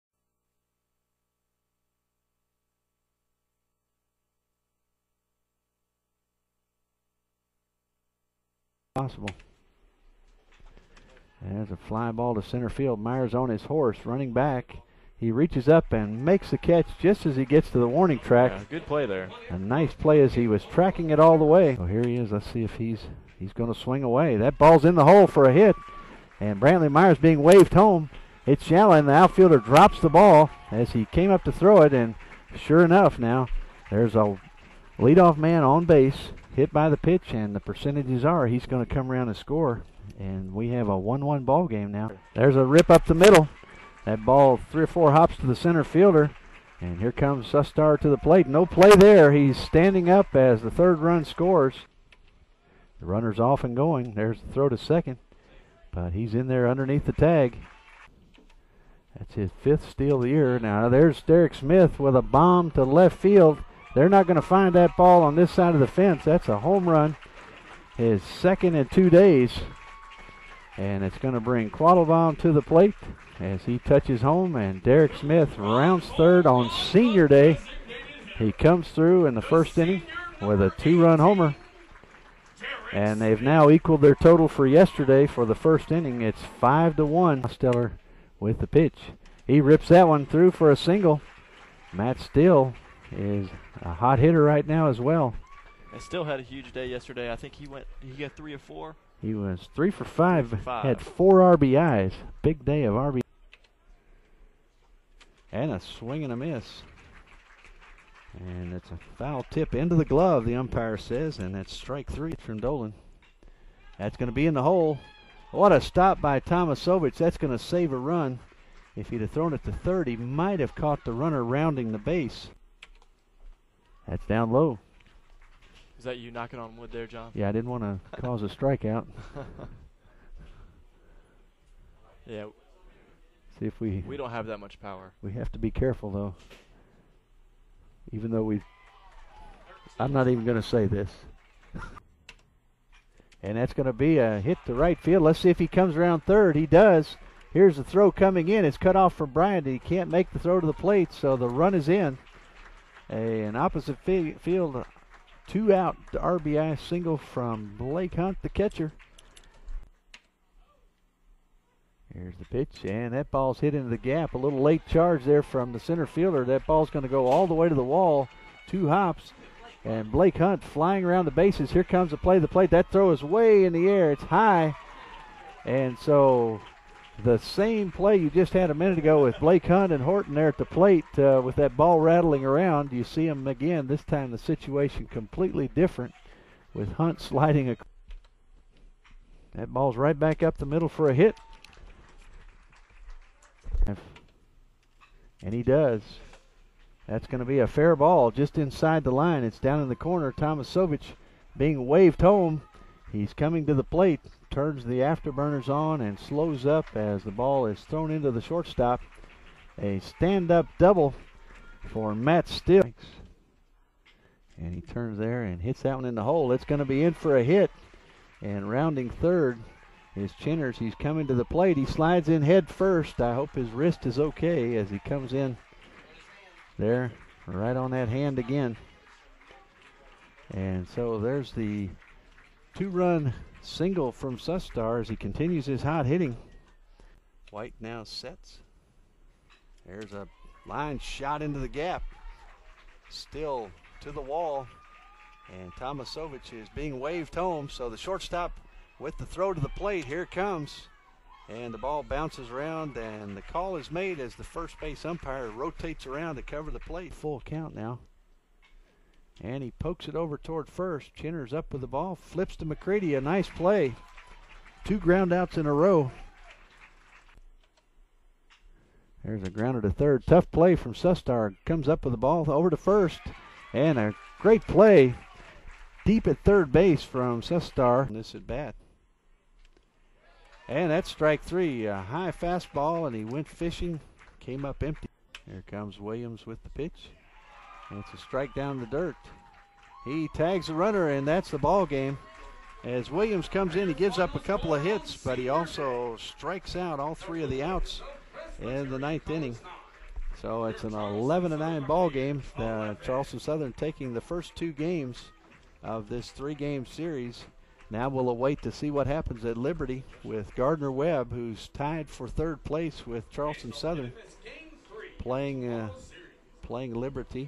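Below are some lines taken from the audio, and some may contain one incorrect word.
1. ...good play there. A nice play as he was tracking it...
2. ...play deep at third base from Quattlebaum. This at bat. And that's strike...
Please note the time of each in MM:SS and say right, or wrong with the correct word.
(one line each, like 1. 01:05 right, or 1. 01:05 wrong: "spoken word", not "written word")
1. 00:18 right
2. 04:34 wrong: "Sustar", not "Quattlebaum".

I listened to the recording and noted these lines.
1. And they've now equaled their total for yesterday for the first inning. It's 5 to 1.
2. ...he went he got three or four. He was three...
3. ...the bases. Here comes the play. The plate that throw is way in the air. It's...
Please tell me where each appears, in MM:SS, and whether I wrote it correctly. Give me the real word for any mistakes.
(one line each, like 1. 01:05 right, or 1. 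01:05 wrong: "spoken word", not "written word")
1. 01:22 right
2. 01:37 right
3. 02:51 right.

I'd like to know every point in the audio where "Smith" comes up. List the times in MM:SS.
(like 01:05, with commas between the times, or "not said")
01:01, 01:15.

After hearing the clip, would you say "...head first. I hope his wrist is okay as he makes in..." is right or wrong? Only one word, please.
wrong.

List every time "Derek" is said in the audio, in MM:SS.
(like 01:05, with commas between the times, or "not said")
01:01, 01:14.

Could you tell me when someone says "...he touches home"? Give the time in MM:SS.
01:13.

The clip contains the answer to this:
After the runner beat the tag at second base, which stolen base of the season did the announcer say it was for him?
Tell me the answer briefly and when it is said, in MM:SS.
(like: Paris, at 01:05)
fifth, at 00:59.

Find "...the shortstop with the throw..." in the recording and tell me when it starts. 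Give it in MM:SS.
04:07.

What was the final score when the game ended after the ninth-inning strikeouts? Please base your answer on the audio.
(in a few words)
11-9.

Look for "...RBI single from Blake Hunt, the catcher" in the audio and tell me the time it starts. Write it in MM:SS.
02:36.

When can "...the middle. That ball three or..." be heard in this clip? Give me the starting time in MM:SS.
00:43.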